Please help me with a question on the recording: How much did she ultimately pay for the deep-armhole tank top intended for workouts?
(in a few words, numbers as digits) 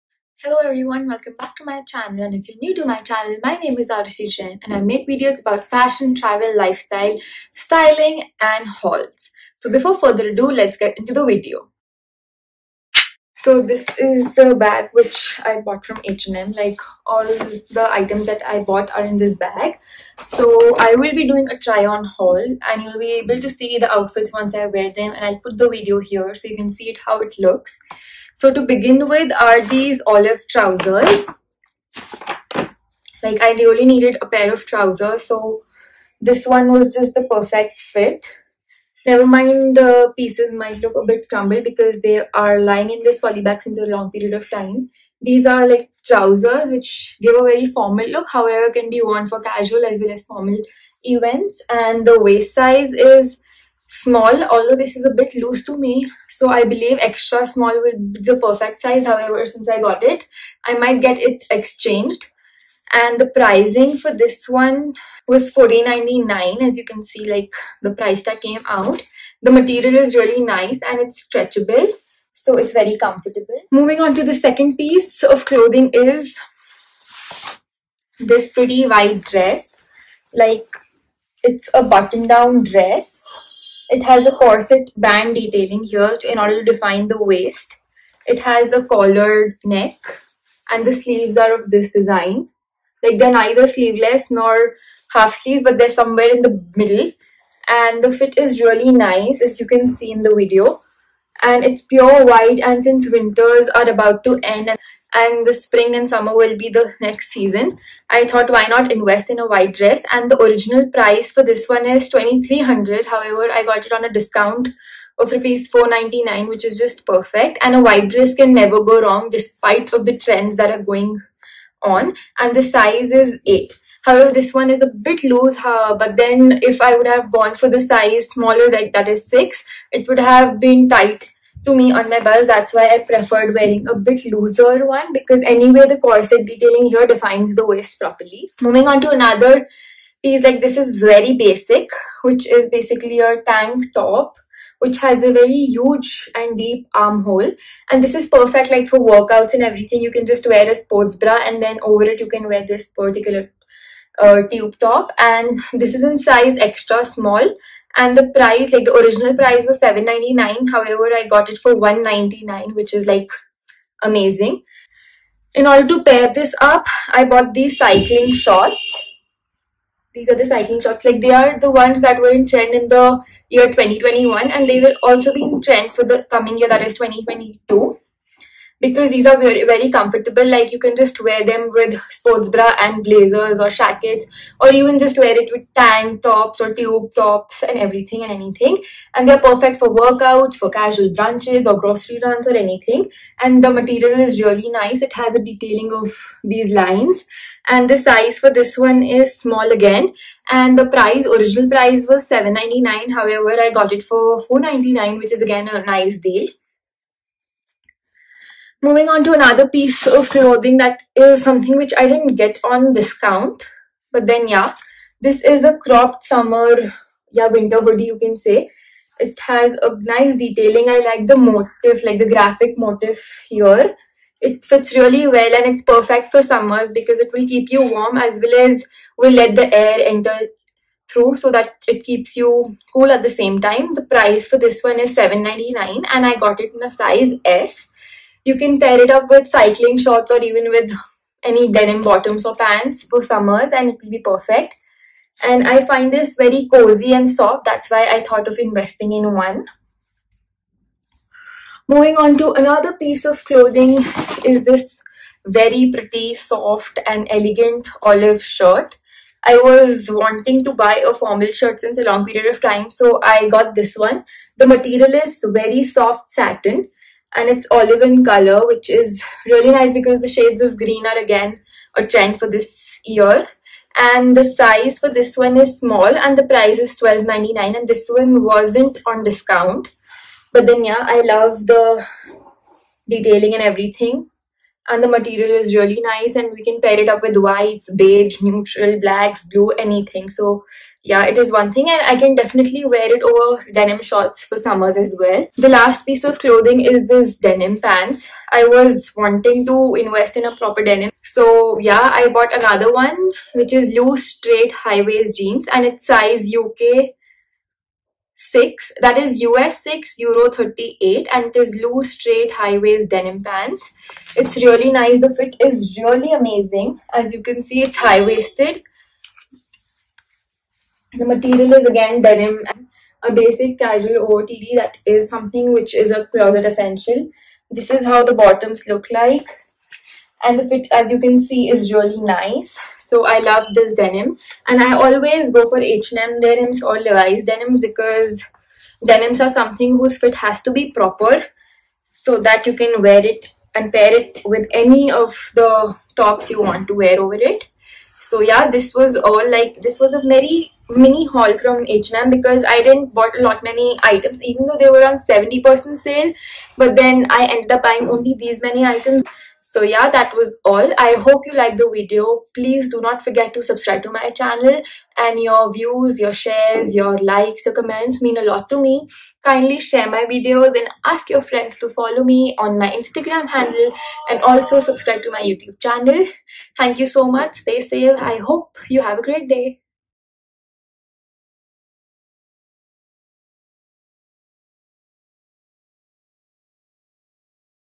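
1.99.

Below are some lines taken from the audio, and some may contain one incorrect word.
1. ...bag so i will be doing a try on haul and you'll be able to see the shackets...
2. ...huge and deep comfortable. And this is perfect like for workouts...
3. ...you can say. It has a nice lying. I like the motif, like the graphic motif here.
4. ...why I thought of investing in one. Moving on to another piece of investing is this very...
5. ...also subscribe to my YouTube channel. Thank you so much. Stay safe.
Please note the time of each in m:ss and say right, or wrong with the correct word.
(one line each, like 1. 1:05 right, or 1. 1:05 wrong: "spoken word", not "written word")
1. 0:19 wrong: "outfits", not "shackets"
2. 2:25 wrong: "armhole", not "comfortable"
3. 3:38 wrong: "detailing", not "lying"
4. 4:07 wrong: "clothing", not "investing"
5. 6:14 right.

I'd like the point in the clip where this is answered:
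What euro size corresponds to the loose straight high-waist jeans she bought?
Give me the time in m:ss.
5:10.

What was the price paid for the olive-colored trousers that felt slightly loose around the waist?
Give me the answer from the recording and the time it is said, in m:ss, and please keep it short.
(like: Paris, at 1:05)
14.99, at 1:05.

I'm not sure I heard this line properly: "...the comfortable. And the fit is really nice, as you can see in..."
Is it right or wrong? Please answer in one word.
wrong.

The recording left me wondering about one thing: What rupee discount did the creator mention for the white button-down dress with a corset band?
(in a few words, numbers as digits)
499.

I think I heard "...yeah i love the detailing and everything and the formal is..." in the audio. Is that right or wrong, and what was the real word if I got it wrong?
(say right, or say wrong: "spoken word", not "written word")
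wrong: "material", not "formal".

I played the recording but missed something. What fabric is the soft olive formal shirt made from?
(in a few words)
Satin.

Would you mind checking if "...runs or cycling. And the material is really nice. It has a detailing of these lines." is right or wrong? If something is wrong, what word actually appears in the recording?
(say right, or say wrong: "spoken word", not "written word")
wrong: "anything", not "cycling".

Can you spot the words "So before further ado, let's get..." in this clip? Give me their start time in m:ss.
0:09.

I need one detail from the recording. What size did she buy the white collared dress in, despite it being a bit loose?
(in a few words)
8.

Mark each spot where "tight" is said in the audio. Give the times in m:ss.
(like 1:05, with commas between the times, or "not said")
2:10.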